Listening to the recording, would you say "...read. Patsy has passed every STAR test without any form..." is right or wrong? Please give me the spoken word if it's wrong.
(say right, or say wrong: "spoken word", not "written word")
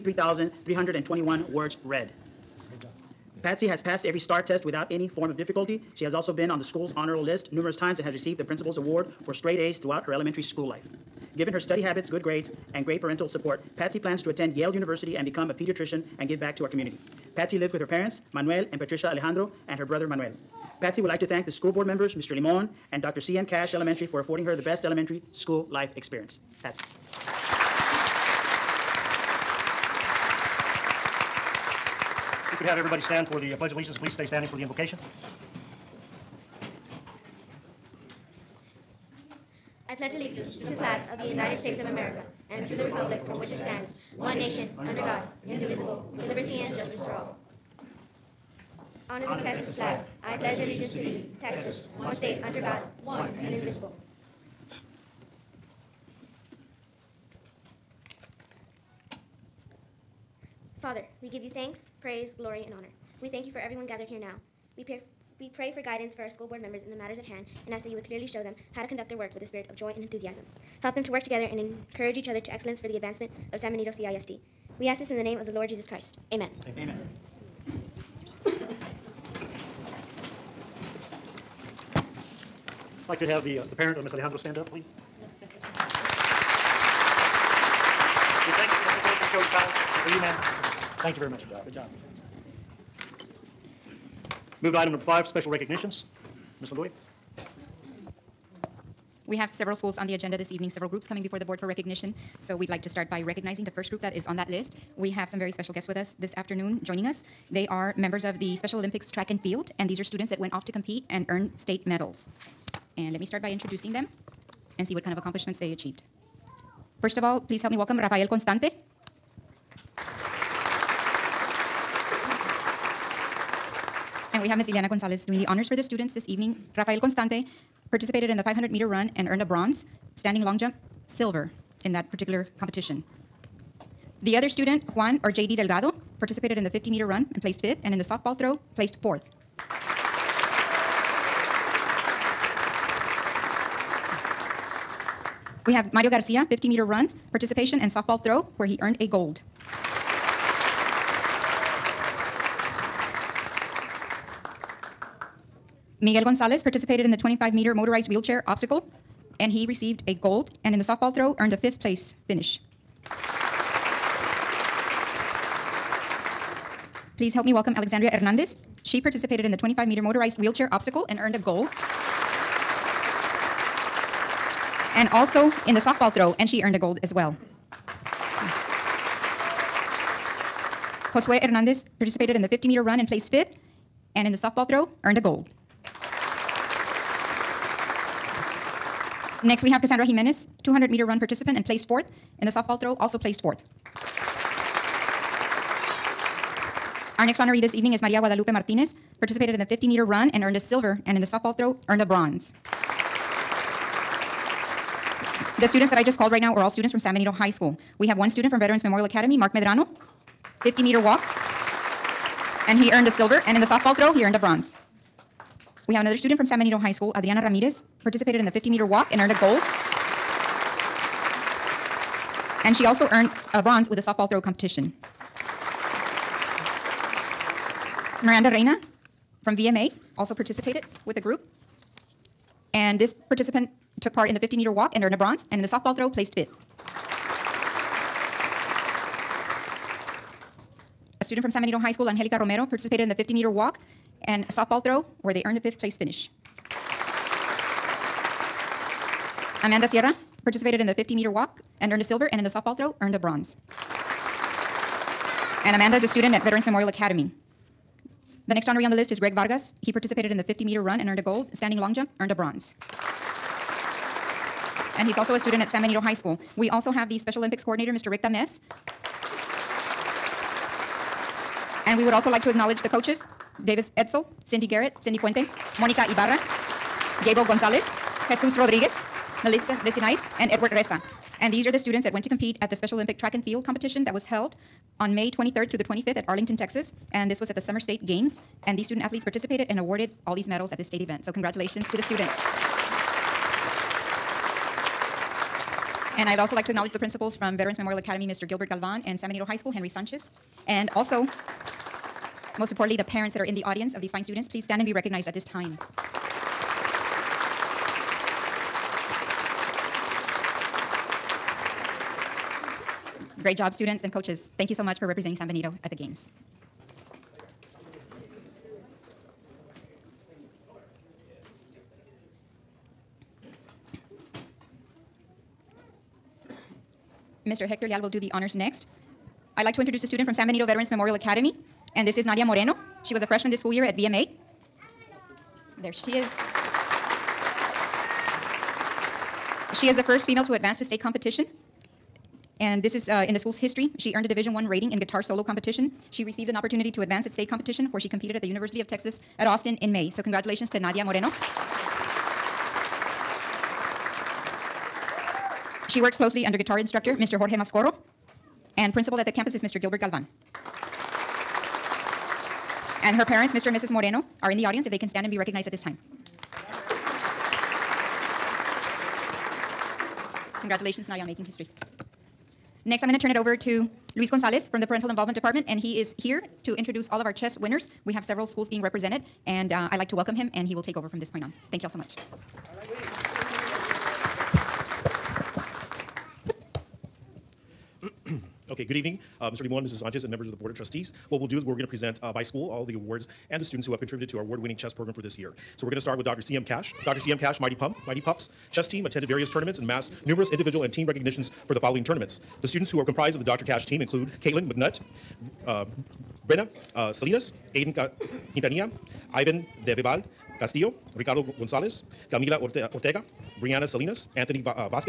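right.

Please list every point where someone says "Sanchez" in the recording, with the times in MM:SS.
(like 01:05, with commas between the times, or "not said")
04:59, 06:30.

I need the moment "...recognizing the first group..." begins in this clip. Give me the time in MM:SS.
01:43.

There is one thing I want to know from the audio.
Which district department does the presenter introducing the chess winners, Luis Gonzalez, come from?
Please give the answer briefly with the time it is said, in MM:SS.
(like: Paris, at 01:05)
Parental Involvement Department, at 06:14.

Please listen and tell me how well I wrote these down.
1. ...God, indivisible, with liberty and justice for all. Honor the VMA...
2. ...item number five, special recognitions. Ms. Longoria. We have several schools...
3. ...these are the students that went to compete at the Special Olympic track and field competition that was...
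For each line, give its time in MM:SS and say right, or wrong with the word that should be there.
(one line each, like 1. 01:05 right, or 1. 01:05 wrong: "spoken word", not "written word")
1. 00:45 wrong: "Texas", not "VMA"
2. 01:34 right
3. 04:41 right.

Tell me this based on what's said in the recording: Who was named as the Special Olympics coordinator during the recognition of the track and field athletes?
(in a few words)
Rick Dames.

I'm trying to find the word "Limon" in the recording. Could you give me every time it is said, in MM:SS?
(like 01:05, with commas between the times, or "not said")
00:22, 06:29.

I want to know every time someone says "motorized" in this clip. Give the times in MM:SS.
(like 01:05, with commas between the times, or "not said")
02:37, 02:50.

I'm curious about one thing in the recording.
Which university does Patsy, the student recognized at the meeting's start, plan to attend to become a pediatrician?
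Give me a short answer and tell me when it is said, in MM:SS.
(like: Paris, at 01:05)
Yale University, at 00:14.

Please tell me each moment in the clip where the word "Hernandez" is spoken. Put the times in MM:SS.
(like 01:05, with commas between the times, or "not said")
02:48, 03:01.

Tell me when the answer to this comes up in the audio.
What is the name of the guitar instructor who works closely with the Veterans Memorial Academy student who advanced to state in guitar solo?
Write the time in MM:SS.
05:57.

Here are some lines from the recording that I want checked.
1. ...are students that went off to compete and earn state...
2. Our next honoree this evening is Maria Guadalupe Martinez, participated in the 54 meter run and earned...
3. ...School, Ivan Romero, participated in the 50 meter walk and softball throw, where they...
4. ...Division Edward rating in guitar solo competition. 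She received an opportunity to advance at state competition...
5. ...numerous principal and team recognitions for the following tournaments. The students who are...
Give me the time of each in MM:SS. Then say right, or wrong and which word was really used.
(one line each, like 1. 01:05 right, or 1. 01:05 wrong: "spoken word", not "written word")
1. 01:49 right
2. 03:17 wrong: "50", not "54"
3. 04:01 wrong: "Angelica", not "Ivan"
4. 05:44 wrong: "One", not "Edward"
5. 06:40 wrong: "individual", not "principal".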